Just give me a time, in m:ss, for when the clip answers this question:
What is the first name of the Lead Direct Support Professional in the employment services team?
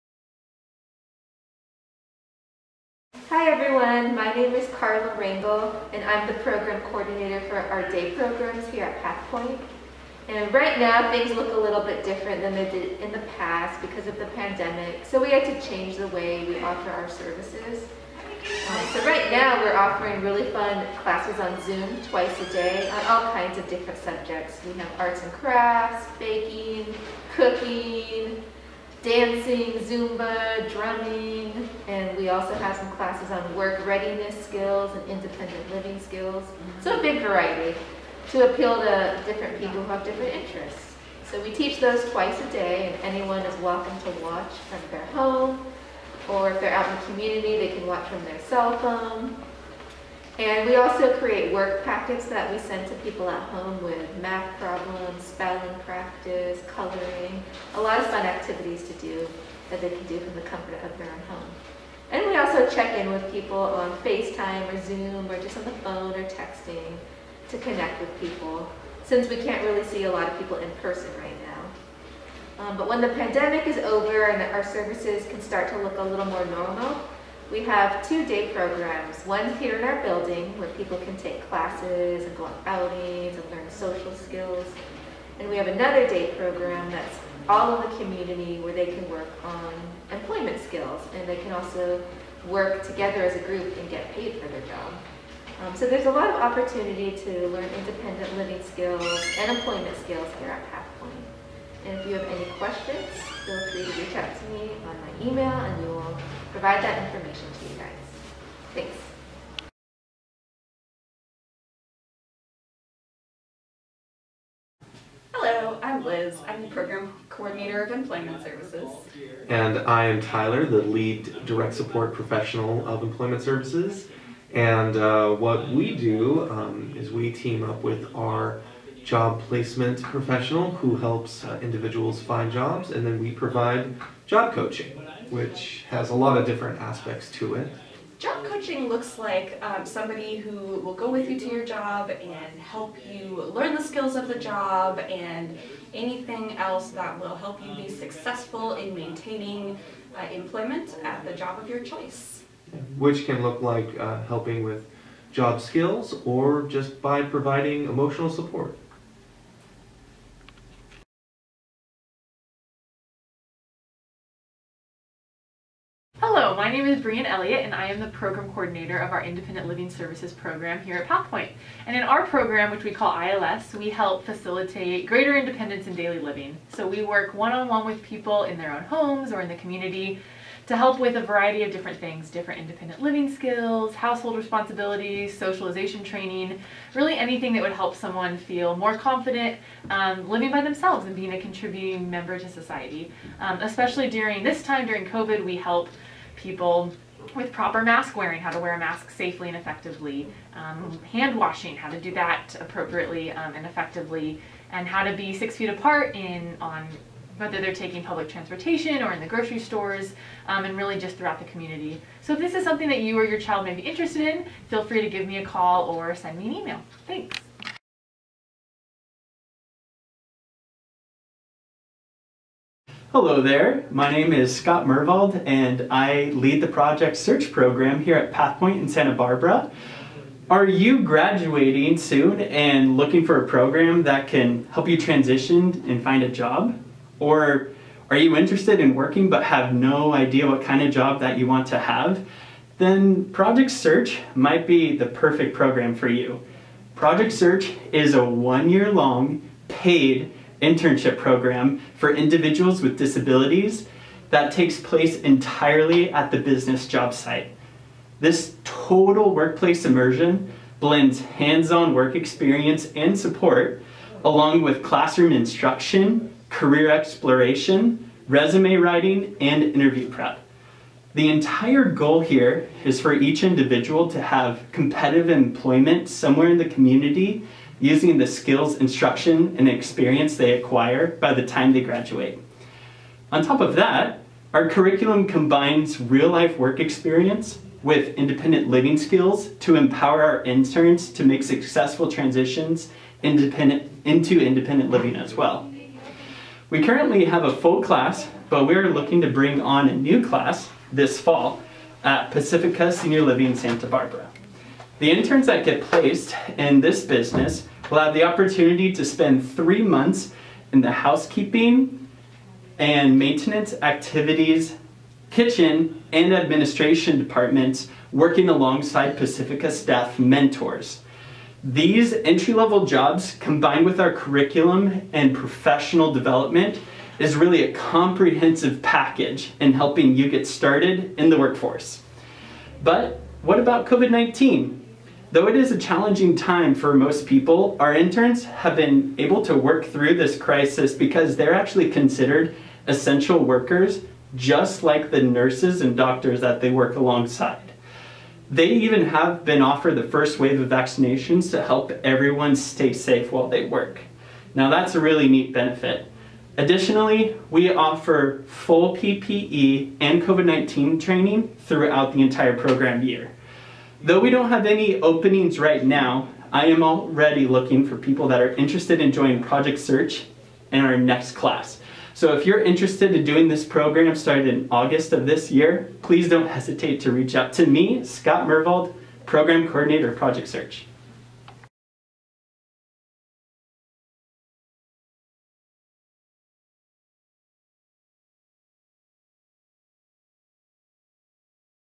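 2:00.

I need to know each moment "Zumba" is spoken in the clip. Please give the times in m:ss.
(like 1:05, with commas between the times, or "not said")
0:29.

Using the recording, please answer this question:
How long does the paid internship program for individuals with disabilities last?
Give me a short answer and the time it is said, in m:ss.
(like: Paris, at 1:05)
One year, at 4:08.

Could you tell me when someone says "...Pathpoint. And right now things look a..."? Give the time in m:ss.
0:09.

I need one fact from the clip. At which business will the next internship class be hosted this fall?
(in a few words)
Pacifica Senior Living Santa Barbara.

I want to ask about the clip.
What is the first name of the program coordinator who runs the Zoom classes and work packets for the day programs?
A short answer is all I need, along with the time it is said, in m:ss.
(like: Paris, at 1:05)
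Carla, at 0:04.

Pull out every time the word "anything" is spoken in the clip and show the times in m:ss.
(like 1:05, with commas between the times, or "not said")
2:25, 3:07.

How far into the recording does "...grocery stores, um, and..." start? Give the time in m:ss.
3:29.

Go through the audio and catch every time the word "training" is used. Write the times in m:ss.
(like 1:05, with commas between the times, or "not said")
3:06, 6:00.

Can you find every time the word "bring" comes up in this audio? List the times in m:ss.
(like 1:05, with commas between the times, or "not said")
4:59.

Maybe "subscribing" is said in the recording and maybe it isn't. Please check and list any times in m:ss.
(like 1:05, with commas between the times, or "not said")
not said.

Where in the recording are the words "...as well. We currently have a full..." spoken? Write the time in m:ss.
4:55.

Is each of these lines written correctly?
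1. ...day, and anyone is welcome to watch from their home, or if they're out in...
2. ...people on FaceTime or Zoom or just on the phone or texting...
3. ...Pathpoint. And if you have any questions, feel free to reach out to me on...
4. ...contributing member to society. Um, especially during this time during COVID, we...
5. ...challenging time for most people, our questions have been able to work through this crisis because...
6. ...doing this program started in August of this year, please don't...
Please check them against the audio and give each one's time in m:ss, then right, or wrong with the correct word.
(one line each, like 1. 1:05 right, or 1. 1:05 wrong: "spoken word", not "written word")
1. 0:42 right
2. 1:03 right
3. 1:40 right
4. 3:11 right
5. 5:35 wrong: "interns", not "questions"
6. 6:13 right.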